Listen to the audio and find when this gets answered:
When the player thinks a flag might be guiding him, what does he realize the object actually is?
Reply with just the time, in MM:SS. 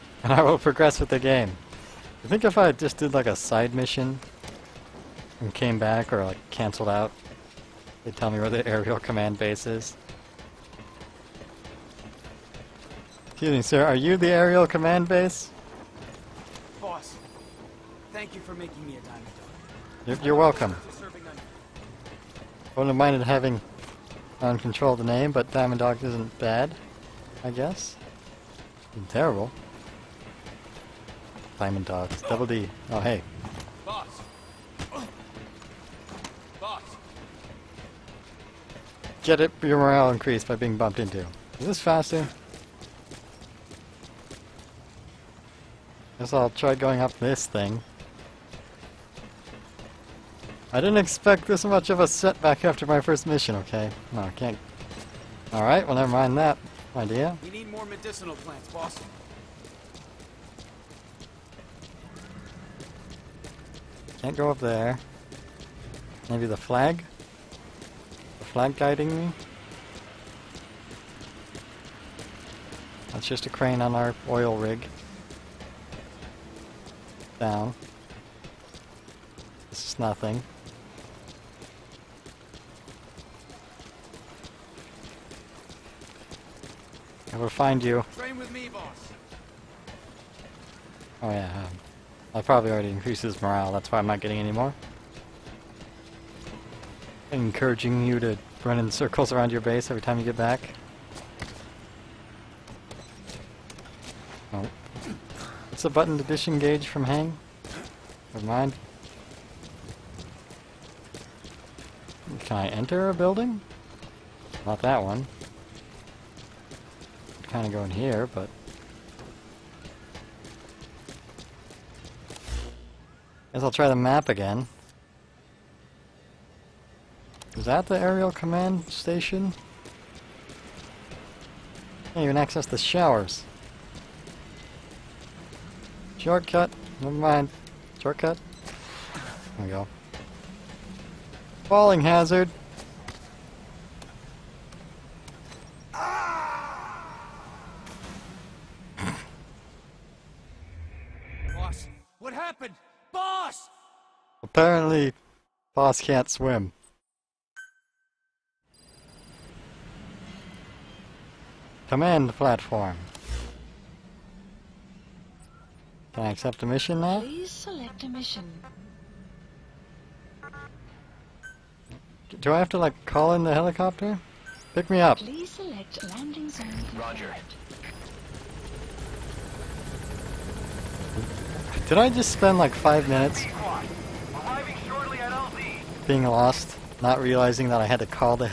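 01:13.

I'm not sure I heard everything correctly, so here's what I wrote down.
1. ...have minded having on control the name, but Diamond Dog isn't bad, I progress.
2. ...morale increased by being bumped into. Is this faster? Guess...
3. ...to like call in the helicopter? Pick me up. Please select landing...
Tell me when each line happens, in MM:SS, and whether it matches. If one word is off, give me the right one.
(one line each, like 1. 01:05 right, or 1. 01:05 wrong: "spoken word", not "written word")
1. 00:22 wrong: "guess", not "progress"
2. 00:39 right
3. 02:52 right.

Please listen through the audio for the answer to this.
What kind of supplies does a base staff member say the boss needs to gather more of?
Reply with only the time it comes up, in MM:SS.
00:57.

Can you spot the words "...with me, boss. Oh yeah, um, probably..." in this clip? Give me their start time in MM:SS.
01:28.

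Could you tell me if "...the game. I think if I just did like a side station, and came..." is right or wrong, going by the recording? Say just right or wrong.
wrong.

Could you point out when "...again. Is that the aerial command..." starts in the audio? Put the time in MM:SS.
02:04.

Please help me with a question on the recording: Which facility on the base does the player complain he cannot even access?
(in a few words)
the showers.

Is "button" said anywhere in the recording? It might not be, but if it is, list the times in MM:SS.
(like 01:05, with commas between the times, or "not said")
01:45.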